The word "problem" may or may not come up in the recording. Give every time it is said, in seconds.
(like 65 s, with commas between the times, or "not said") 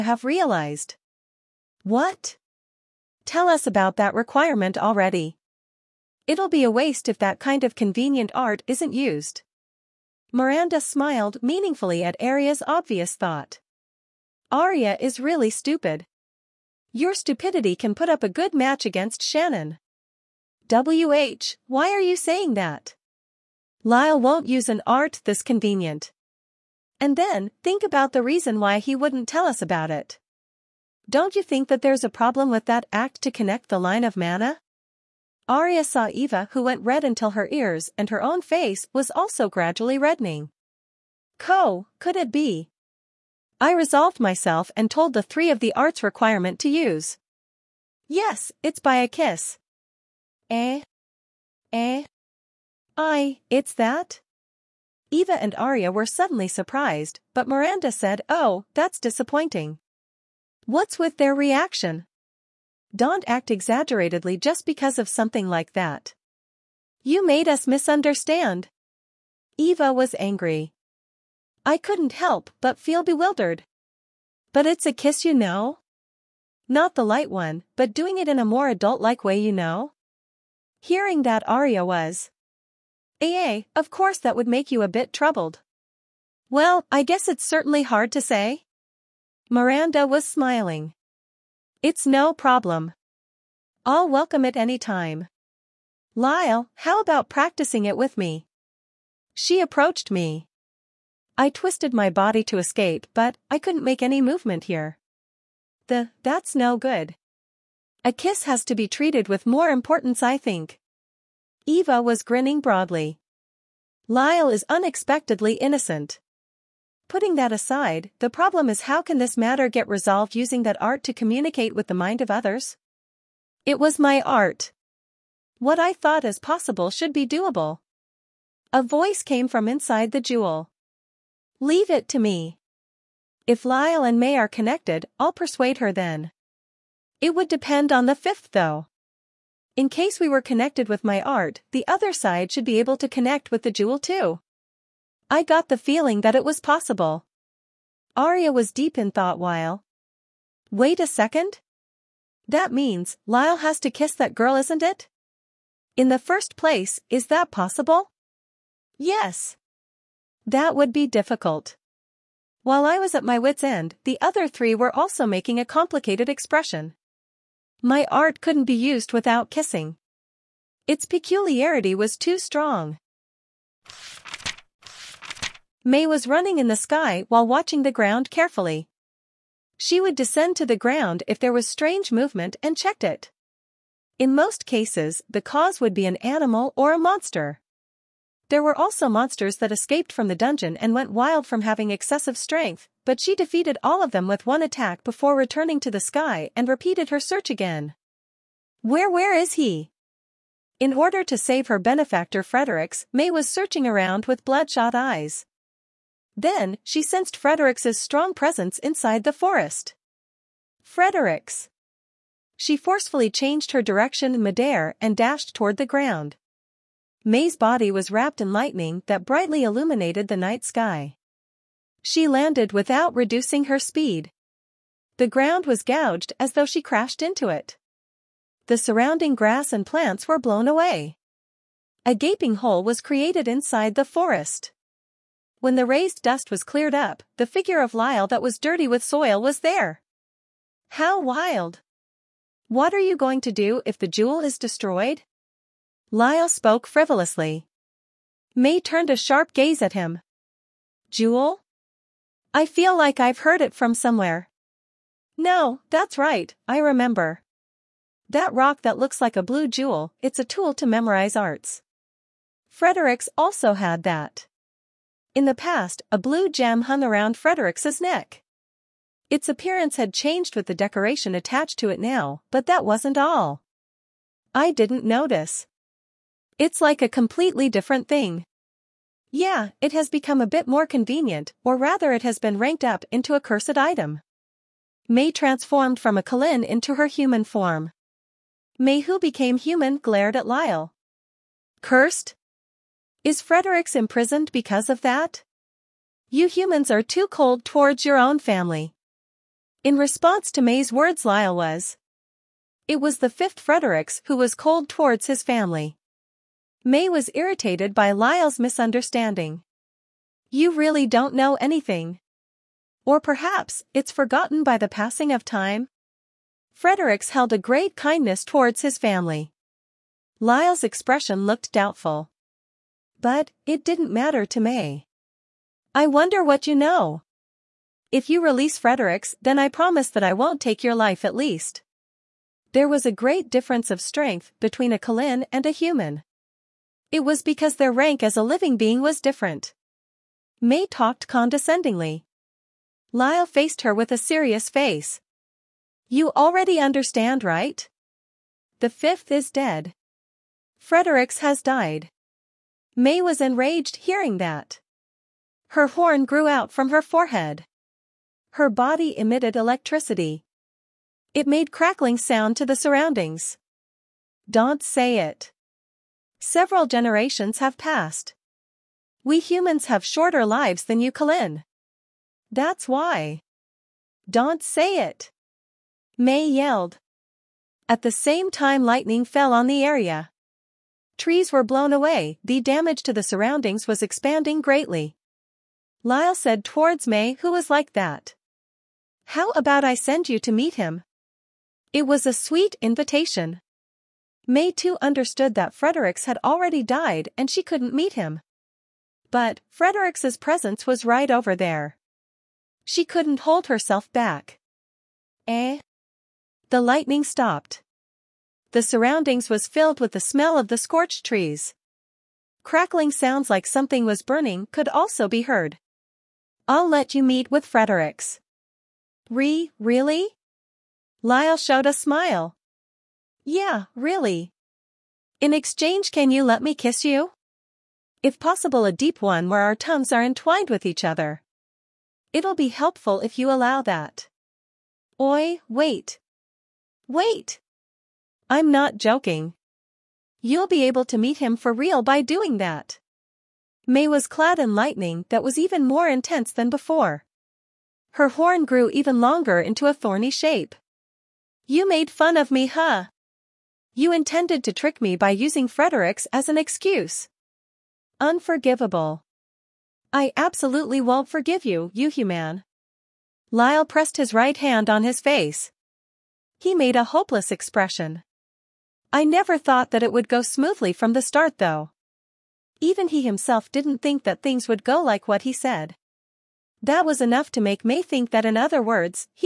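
32 s, 92 s, 118 s.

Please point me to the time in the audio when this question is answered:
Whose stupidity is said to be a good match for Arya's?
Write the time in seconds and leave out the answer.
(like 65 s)
19 s.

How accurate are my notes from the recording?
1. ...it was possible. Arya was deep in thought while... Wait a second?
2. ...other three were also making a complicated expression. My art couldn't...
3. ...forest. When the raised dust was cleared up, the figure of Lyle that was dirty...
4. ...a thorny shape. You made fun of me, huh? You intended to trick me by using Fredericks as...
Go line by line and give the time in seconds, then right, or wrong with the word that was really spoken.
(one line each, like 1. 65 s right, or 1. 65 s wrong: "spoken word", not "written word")
1. 146 s right
2. 164 s right
3. 234 s right
4. 449 s right.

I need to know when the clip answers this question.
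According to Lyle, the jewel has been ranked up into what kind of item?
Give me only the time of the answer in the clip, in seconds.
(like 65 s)
283 s.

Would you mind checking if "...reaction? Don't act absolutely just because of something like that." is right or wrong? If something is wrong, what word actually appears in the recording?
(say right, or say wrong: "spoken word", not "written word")
wrong: "exaggeratedly", not "absolutely".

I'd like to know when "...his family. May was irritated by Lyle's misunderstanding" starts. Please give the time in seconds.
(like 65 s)
305 s.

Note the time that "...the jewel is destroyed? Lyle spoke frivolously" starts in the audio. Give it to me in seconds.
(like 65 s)
243 s.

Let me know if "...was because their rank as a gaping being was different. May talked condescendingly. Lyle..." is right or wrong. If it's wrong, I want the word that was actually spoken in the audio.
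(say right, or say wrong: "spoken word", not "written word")
wrong: "living", not "gaping".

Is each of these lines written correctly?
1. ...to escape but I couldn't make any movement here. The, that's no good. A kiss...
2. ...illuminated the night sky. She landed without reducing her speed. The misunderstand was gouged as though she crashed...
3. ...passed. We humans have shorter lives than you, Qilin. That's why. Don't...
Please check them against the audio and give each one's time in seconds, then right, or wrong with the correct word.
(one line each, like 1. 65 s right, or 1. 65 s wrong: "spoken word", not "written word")
1. 102 s right
2. 219 s wrong: "ground", not "misunderstand"
3. 367 s right.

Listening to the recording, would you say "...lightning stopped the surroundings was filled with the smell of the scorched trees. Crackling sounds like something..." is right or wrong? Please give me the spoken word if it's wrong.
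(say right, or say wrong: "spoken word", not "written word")
right.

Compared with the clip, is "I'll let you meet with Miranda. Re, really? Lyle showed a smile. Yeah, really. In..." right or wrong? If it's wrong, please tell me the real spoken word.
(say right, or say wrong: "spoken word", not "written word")
wrong: "Fredericks", not "Miranda".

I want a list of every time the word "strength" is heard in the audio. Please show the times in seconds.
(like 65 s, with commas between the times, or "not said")
192 s, 333 s.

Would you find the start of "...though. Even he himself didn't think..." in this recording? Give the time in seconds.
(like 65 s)
471 s.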